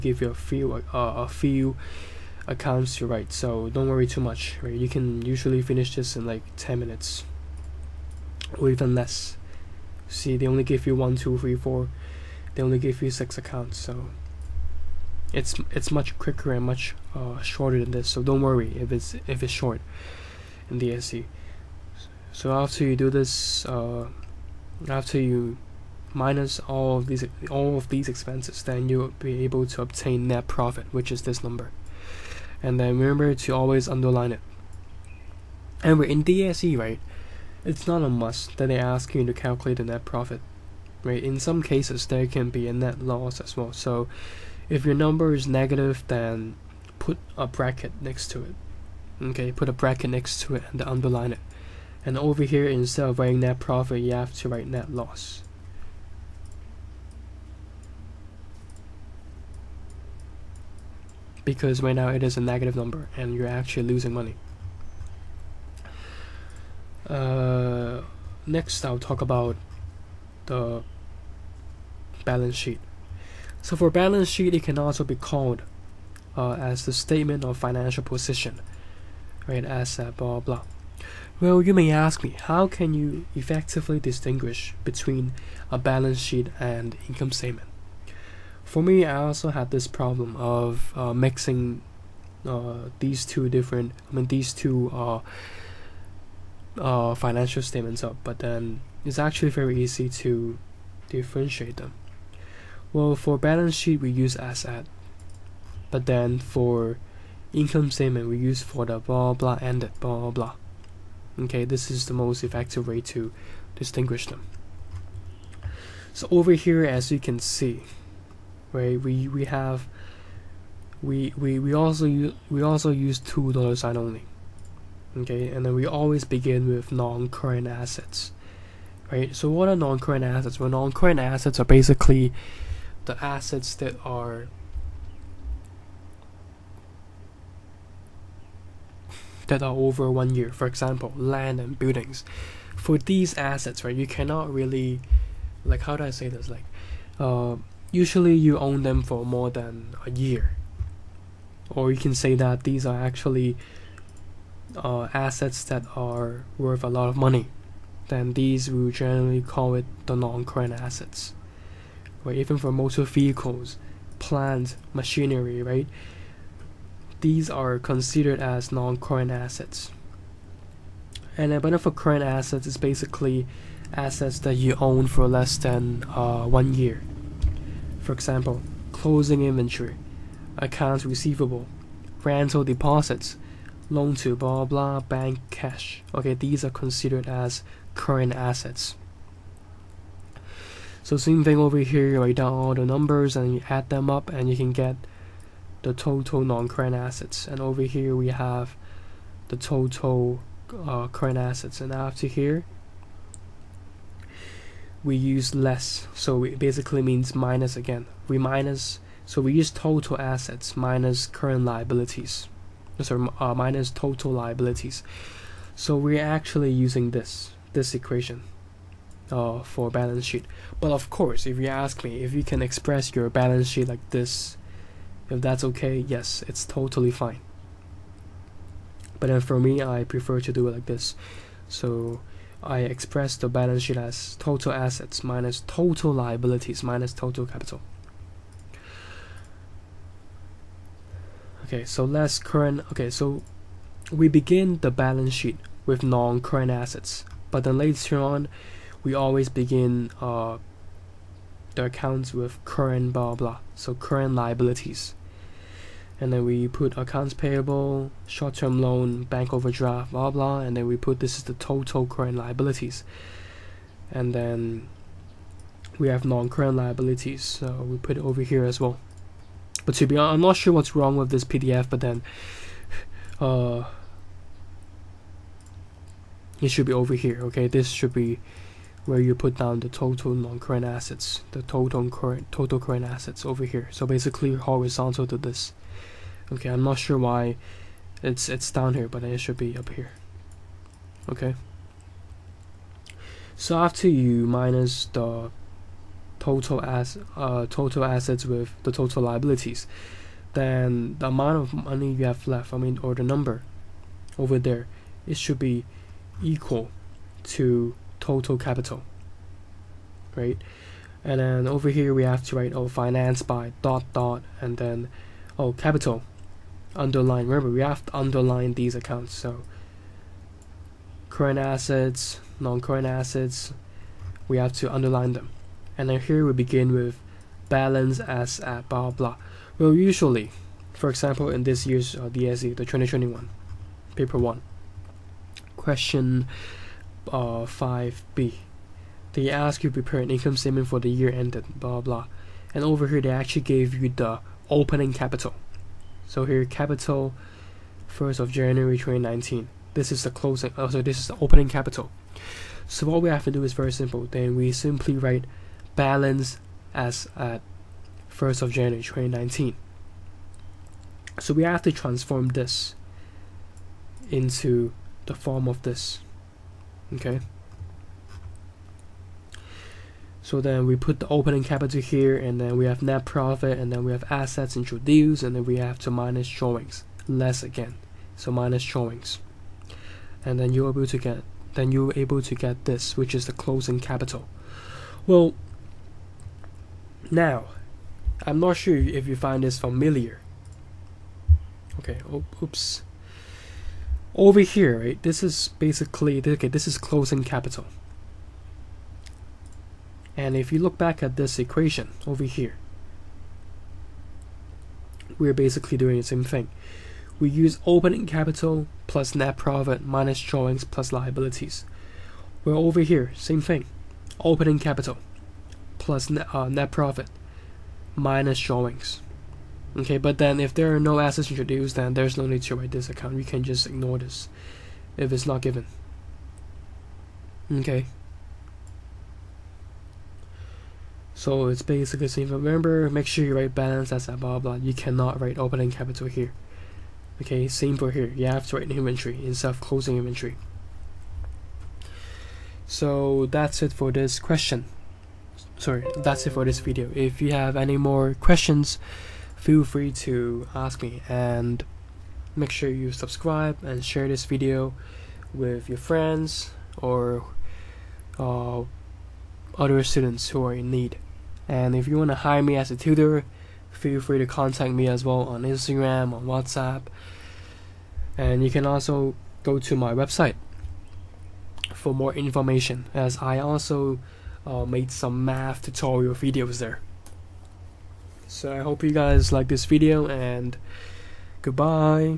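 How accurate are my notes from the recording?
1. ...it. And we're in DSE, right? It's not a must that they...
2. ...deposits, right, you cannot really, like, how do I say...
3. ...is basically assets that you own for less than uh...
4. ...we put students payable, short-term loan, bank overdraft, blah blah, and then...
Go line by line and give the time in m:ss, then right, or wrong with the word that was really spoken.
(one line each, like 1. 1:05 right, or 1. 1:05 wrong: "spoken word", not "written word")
1. 0:34 right
2. 2:23 wrong: "assets", not "deposits"
3. 2:52 right
4. 4:16 wrong: "accounts", not "students".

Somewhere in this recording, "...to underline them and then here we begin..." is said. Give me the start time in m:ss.
5:24.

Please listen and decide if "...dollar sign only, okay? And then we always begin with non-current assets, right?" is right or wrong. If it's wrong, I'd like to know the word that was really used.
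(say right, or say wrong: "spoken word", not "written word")
right.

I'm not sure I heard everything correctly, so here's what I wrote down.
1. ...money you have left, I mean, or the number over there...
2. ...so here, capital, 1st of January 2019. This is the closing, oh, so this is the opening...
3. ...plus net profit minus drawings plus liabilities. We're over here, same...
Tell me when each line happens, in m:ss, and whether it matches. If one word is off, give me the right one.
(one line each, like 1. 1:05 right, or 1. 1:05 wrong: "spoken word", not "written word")
1. 5:01 right
2. 5:46 right
3. 6:49 right.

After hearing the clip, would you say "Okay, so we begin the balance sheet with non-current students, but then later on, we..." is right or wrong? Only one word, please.
wrong.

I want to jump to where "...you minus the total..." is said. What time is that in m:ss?
4:54.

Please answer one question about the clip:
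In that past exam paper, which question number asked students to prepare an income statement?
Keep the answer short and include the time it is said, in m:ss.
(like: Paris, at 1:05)
5b, at 5:37.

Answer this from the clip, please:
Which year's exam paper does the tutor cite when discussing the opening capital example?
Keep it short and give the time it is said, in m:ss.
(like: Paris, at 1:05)
2021, at 5:32.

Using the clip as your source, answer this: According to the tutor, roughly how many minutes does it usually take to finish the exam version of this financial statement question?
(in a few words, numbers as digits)
10 minutes.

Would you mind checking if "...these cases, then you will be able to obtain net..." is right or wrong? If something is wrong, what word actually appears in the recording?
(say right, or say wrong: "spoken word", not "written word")
wrong: "expenses", not "cases".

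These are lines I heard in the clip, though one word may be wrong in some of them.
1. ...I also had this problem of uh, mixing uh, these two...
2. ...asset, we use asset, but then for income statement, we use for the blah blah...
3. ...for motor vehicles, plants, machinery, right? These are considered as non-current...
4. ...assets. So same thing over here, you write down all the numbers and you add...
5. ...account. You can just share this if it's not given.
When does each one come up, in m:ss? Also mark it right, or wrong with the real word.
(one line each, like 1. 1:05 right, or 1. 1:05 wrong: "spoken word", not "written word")
1. 1:29 right
2. 1:43 wrong: "sheet", not "asset"
3. 2:42 right
4. 3:08 right
5. 7:03 wrong: "ignore", not "share".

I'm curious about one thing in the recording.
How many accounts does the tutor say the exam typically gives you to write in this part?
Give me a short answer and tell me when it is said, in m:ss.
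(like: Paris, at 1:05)
6, at 0:13.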